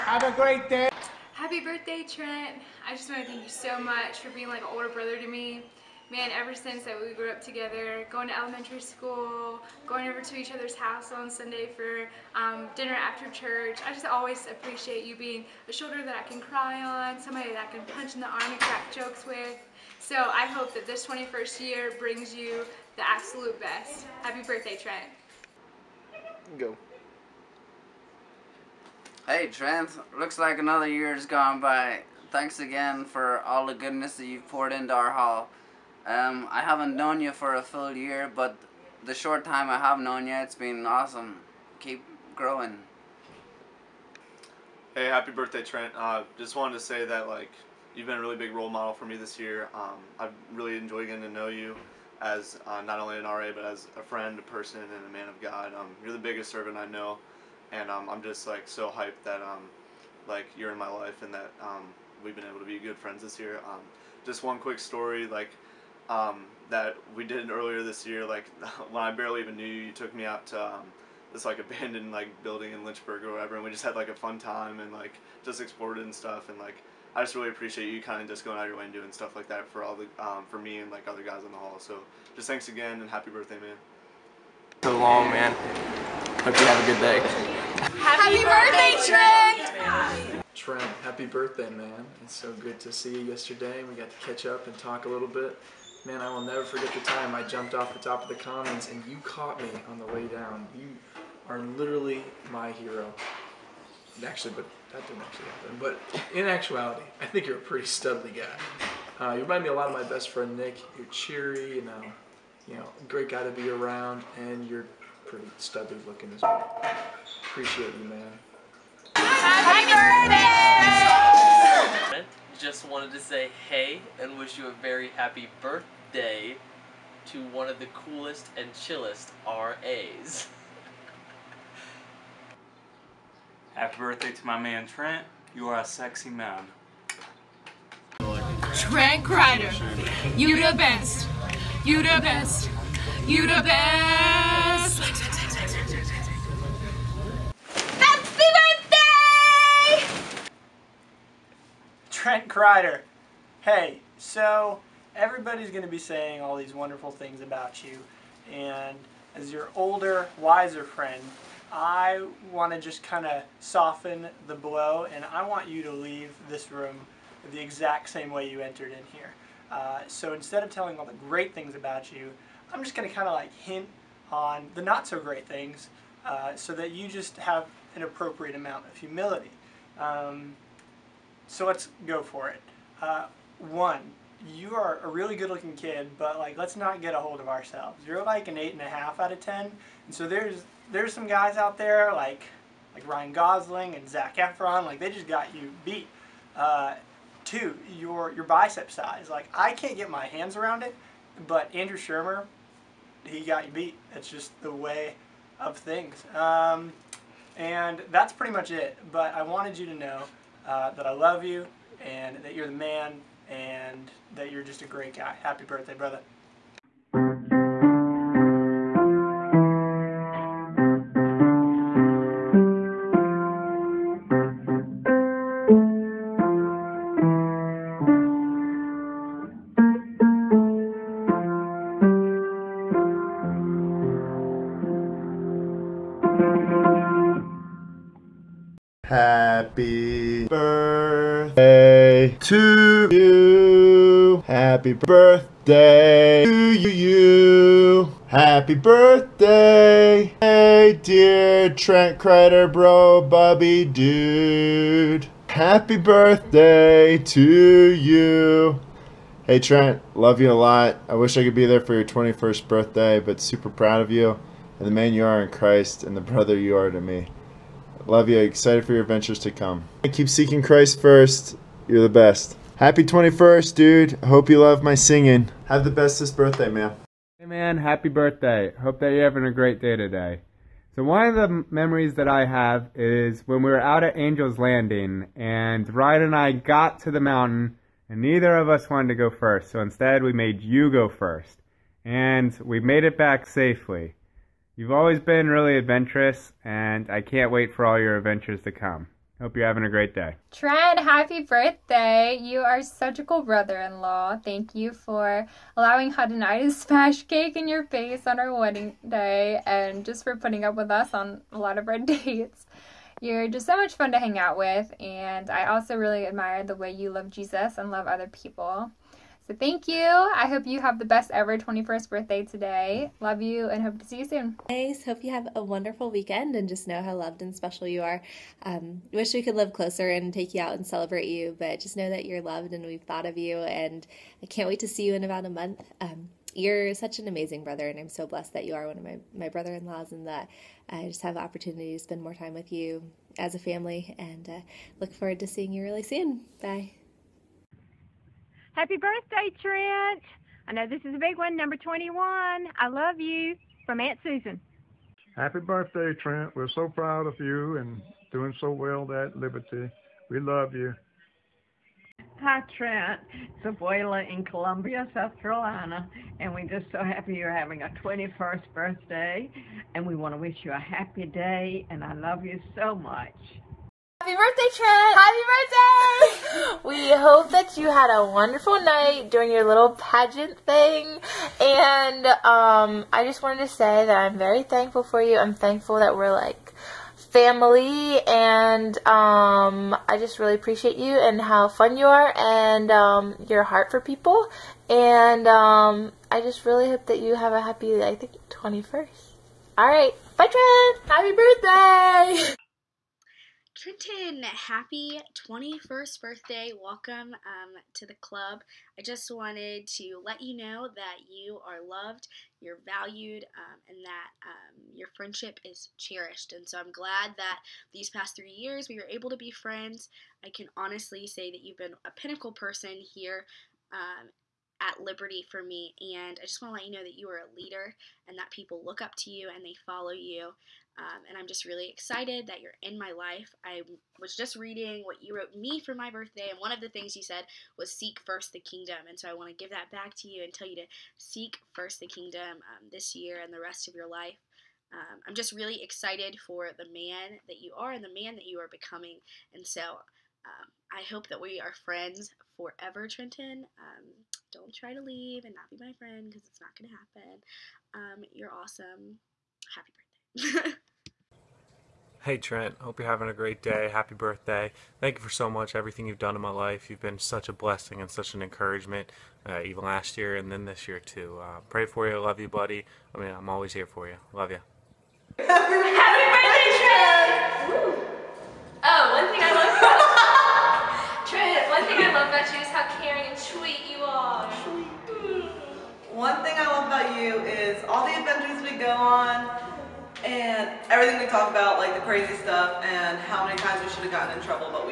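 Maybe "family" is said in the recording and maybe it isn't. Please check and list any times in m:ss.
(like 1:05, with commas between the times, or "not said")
5:43, 6:27.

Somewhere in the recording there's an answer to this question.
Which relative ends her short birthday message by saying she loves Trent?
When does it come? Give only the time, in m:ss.
5:54.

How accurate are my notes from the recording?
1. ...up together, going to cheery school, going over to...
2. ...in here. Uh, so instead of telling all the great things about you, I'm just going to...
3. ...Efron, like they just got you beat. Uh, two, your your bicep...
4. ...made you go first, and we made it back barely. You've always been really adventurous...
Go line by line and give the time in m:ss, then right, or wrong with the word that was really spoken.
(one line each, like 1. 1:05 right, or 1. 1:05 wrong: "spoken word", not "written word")
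1. 0:07 wrong: "elementary", not "cheery"
2. 2:48 right
3. 3:14 right
4. 4:50 wrong: "safely", not "barely".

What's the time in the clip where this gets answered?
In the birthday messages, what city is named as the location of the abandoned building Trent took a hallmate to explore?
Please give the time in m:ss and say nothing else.
1:12.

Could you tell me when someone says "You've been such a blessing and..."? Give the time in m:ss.
7:46.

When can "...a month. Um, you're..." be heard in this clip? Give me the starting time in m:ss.
5:35.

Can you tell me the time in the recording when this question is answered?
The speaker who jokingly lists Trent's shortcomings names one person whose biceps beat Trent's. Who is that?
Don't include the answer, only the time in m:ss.
3:21.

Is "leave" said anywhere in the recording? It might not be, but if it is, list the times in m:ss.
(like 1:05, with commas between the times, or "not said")
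2:45, 7:35.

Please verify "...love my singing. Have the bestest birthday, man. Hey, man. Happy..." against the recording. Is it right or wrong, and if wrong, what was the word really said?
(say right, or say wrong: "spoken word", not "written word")
right.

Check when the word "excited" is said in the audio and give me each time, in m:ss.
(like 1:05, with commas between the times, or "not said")
4:28, 7:11, 7:25.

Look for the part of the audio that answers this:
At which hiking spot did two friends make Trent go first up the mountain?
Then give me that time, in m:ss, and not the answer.
4:44.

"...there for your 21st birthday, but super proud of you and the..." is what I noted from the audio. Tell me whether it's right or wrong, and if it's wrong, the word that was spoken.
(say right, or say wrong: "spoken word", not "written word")
right.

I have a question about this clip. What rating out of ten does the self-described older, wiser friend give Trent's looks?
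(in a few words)
8.5.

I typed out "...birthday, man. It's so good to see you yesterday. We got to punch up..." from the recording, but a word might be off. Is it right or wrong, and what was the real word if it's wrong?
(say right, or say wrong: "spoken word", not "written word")
wrong: "catch", not "punch".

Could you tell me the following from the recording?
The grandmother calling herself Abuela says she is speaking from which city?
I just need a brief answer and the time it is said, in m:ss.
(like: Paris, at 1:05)
Columbia, South Carolina, at 6:04.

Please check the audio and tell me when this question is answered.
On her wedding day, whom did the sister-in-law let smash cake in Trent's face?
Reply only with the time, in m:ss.
5:06.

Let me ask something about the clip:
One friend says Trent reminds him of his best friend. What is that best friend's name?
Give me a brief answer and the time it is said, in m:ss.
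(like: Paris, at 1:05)
Nick, at 1:50.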